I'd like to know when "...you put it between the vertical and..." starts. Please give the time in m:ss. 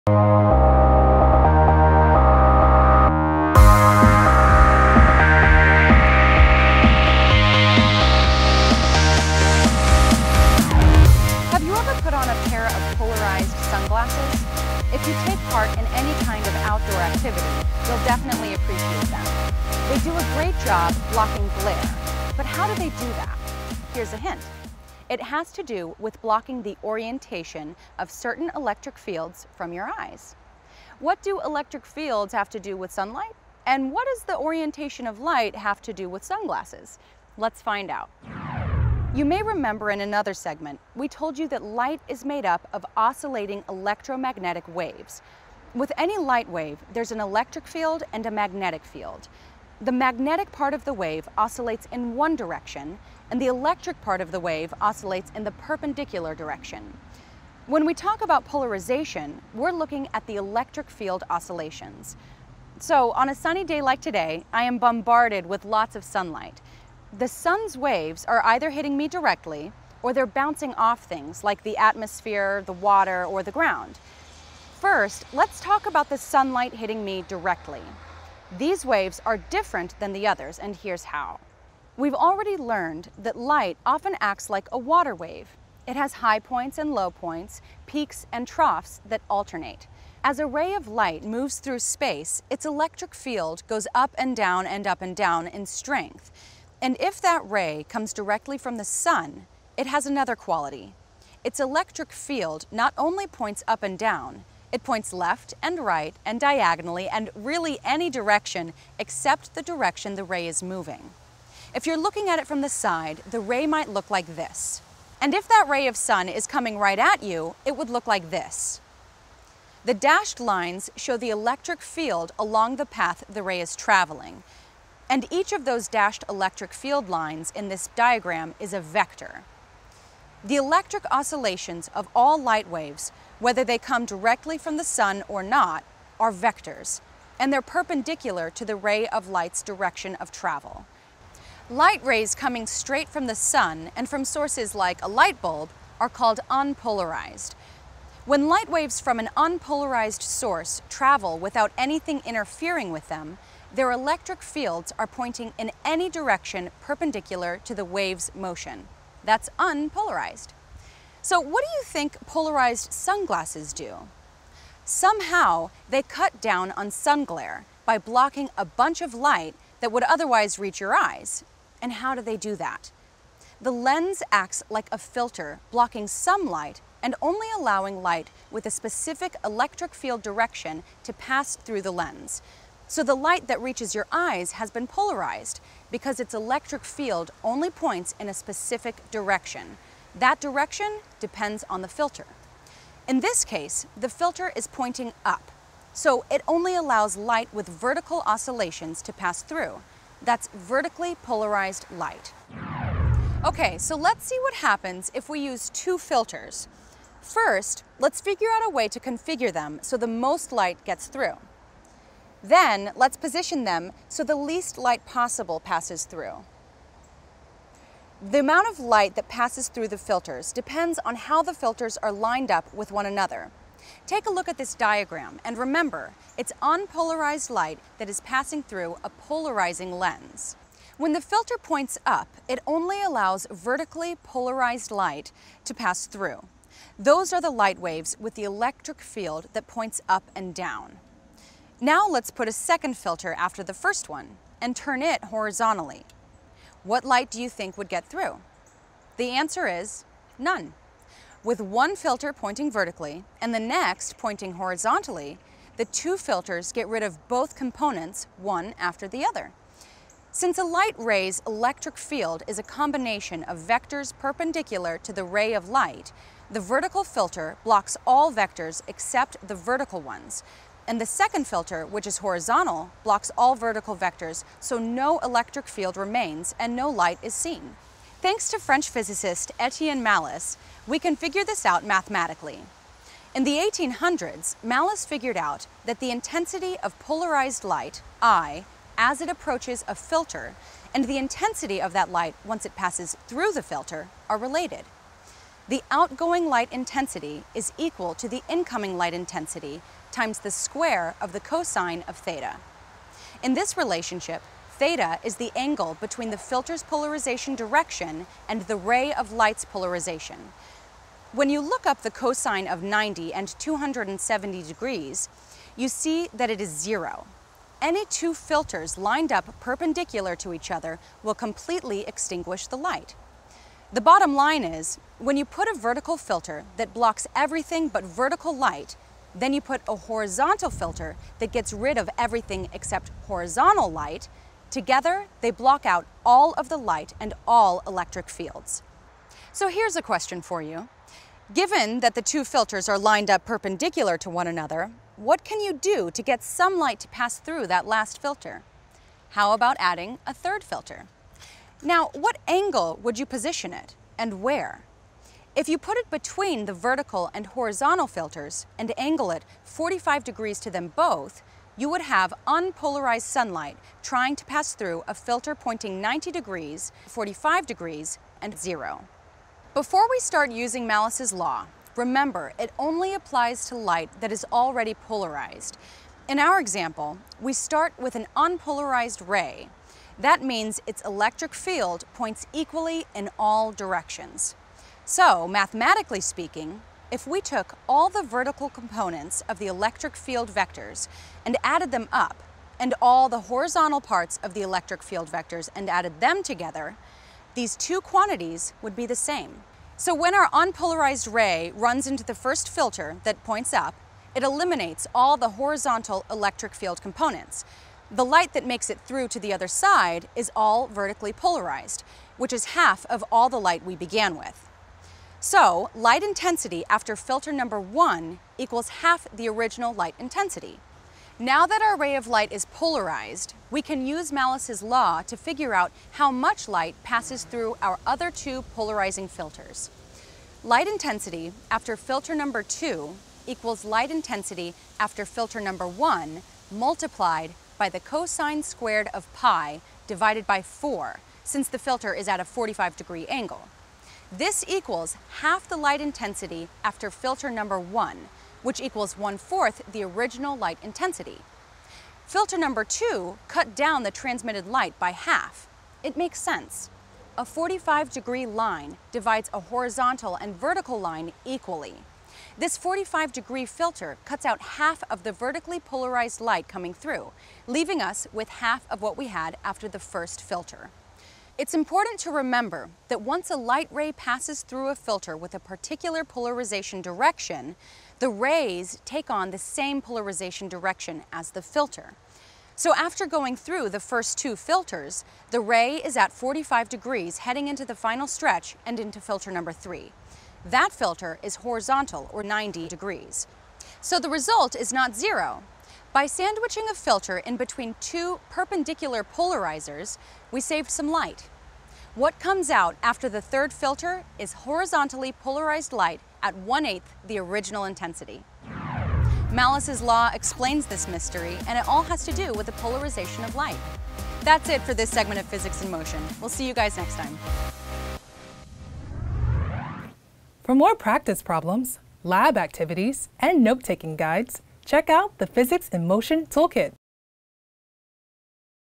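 5:55.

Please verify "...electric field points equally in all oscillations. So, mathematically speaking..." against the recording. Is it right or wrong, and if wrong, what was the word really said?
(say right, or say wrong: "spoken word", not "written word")
wrong: "directions", not "oscillations".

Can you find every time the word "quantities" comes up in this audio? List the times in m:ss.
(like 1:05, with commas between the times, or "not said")
6:37.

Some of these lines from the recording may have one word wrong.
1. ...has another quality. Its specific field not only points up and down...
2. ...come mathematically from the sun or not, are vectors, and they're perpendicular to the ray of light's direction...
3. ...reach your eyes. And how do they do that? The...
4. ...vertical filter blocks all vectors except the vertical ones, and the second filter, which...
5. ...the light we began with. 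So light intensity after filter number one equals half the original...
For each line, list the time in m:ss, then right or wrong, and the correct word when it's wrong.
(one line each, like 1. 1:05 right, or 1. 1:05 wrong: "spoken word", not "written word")
1. 1:39 wrong: "electric", not "specific"
2. 2:13 wrong: "directly", not "mathematically"
3. 2:50 right
4. 4:26 right
5. 6:53 right.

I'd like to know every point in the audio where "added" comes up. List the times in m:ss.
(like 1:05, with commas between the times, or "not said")
6:31, 6:35.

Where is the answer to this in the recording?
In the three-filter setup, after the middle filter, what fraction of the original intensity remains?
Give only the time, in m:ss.
7:29.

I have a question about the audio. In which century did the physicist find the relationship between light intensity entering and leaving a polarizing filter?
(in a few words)
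1800s.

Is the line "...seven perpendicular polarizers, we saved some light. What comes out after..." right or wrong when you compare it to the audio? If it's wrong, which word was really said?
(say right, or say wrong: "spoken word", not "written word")
wrong: "two", not "seven".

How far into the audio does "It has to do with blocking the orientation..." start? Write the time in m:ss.
0:25.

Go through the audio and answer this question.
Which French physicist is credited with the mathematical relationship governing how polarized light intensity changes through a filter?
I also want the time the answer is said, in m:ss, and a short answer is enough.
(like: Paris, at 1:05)
Etienne Malus, at 4:39.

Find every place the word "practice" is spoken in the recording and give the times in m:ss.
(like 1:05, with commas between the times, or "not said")
8:40.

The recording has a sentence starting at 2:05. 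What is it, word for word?
And each of those dashed electric field lines in this diagram is a vector.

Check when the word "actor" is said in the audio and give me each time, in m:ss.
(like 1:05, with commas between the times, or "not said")
not said.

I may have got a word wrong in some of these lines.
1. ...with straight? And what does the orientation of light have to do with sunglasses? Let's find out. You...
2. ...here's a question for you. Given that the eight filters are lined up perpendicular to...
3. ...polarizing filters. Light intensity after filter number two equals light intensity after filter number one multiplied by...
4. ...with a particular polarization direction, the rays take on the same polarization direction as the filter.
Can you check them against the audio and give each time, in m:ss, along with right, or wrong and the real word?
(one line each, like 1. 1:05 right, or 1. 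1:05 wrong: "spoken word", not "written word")
1. 0:32 wrong: "sunlight", not "straight"
2. 5:39 wrong: "two", not "eight"
3. 7:08 right
4. 7:55 right.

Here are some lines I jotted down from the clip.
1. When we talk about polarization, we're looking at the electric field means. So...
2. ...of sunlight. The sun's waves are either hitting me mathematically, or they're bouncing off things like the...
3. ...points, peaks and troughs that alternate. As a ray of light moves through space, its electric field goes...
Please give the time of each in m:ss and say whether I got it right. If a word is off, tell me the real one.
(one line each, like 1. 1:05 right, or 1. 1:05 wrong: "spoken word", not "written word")
1. 0:57 wrong: "oscillations", not "means"
2. 1:05 wrong: "directly", not "mathematically"
3. 1:27 right.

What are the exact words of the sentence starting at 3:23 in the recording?
Okay, so let's see what happens if we use two filters.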